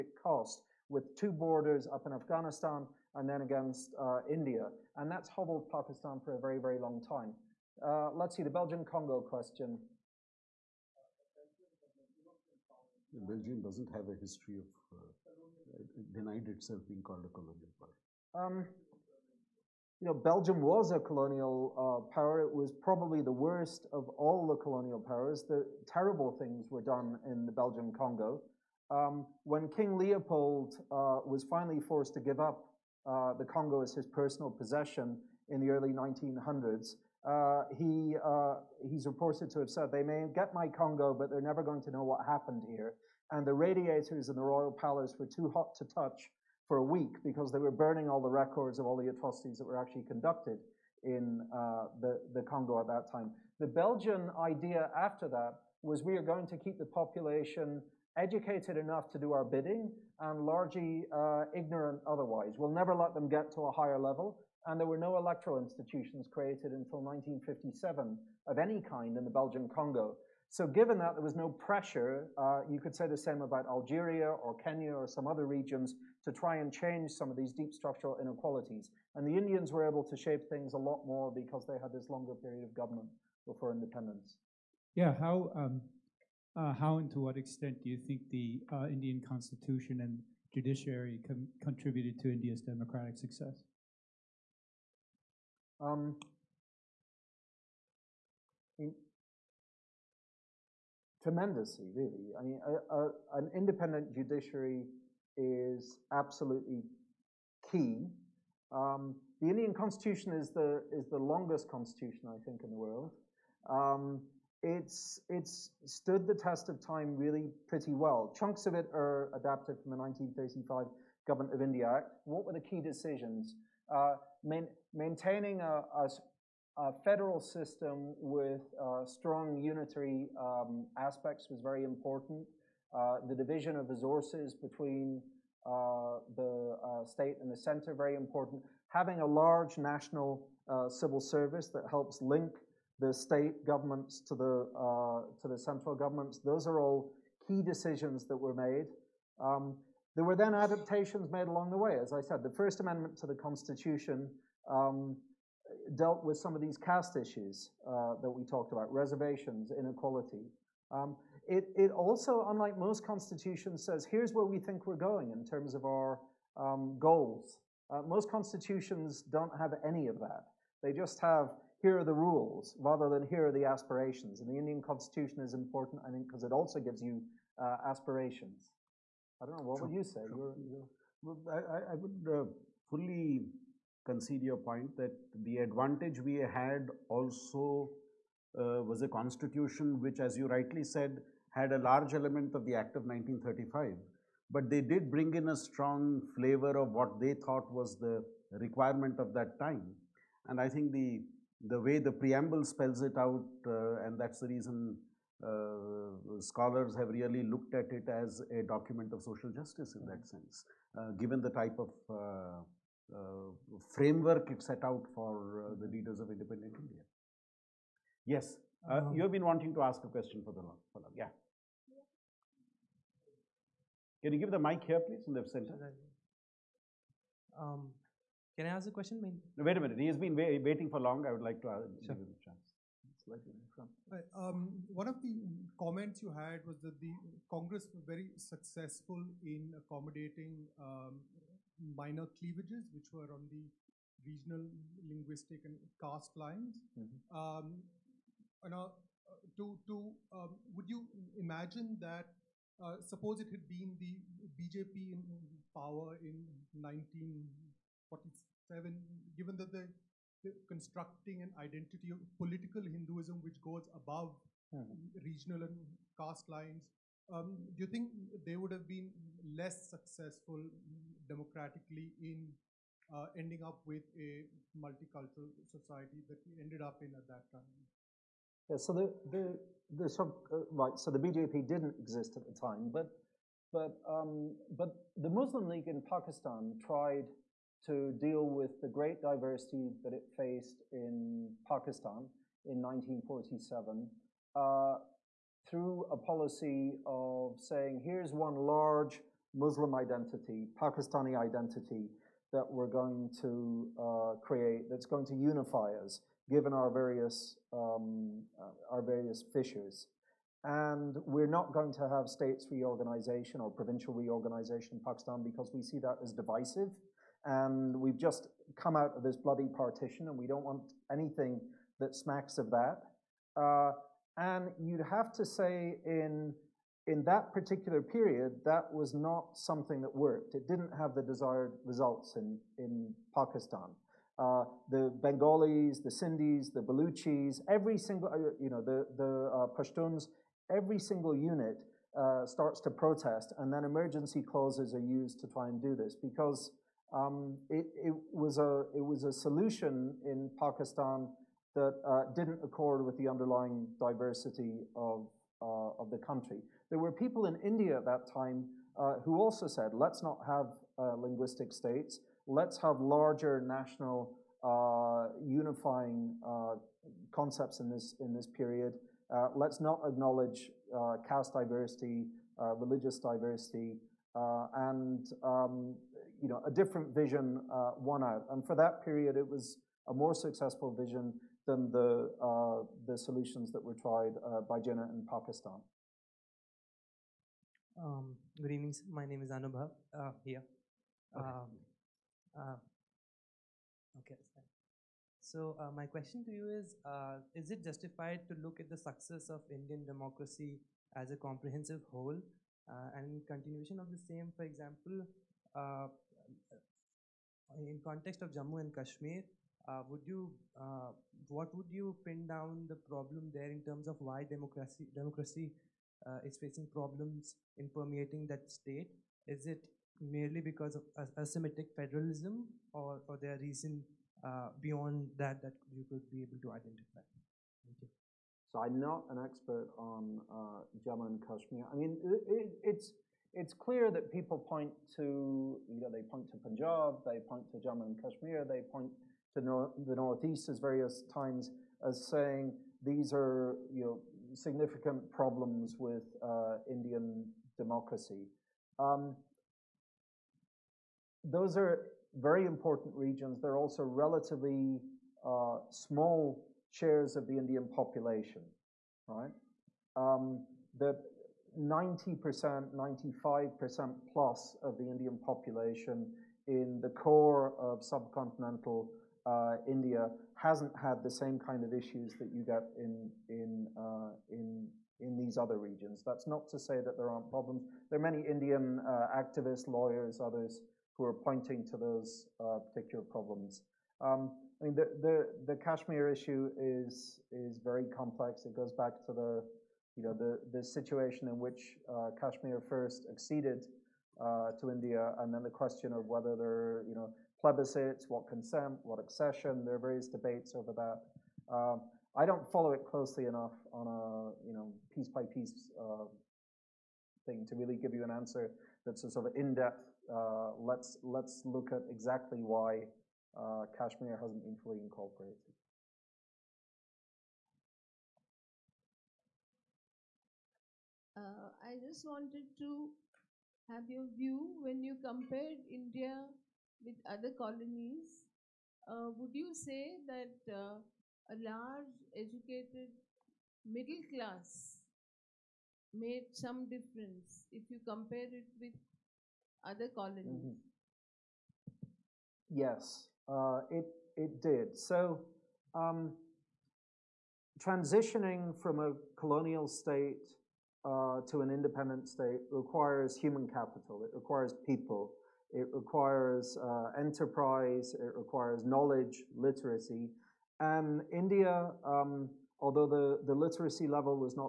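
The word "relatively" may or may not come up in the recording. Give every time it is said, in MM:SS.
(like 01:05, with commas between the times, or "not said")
07:34.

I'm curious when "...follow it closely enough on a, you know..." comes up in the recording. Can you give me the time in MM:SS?
08:22.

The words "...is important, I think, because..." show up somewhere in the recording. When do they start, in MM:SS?
02:55.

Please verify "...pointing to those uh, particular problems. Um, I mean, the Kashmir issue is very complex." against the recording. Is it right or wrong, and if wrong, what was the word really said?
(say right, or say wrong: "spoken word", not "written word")
right.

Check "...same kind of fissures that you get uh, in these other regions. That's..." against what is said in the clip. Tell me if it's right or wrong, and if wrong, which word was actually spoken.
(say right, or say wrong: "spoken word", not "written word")
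wrong: "issues", not "fissures".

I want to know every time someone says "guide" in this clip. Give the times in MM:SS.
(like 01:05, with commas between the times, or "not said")
not said.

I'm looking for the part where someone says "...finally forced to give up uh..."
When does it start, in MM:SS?
00:31.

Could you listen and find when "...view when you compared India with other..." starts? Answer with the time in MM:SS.
08:44.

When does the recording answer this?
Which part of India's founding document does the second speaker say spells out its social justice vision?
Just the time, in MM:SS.
03:22.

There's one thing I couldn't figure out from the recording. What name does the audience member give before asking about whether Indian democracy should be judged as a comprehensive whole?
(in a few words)
Anubhav.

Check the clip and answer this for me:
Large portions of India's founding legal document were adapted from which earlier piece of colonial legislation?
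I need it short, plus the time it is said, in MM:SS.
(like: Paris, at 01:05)
1935 Government of India Act, at 01:59.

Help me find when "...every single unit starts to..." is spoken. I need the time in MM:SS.
05:40.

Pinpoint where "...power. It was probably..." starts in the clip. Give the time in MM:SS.
00:22.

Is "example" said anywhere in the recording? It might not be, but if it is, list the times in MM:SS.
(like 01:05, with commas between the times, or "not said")
06:44.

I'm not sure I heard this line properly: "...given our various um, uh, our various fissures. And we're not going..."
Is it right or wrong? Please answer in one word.
right.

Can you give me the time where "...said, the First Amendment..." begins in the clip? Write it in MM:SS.
02:32.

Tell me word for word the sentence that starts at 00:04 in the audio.
And that's hobbled Pakistan for a very, very long time.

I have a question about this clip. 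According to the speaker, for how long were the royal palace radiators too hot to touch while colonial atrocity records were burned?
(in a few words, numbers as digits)
a week.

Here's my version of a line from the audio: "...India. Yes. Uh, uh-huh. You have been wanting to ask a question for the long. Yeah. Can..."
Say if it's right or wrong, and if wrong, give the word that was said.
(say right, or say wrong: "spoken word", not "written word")
right.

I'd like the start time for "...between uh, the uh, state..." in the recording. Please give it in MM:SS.
02:14.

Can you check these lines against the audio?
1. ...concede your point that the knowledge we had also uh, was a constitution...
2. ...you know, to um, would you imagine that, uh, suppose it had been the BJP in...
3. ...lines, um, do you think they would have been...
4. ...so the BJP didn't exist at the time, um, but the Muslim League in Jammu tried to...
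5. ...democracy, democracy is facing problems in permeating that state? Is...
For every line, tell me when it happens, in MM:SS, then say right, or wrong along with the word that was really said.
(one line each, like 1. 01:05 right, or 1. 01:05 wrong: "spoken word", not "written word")
1. 03:04 wrong: "advantage", not "knowledge"
2. 04:08 right
3. 04:26 right
4. 04:40 wrong: "Pakistan", not "Jammu"
5. 06:54 right.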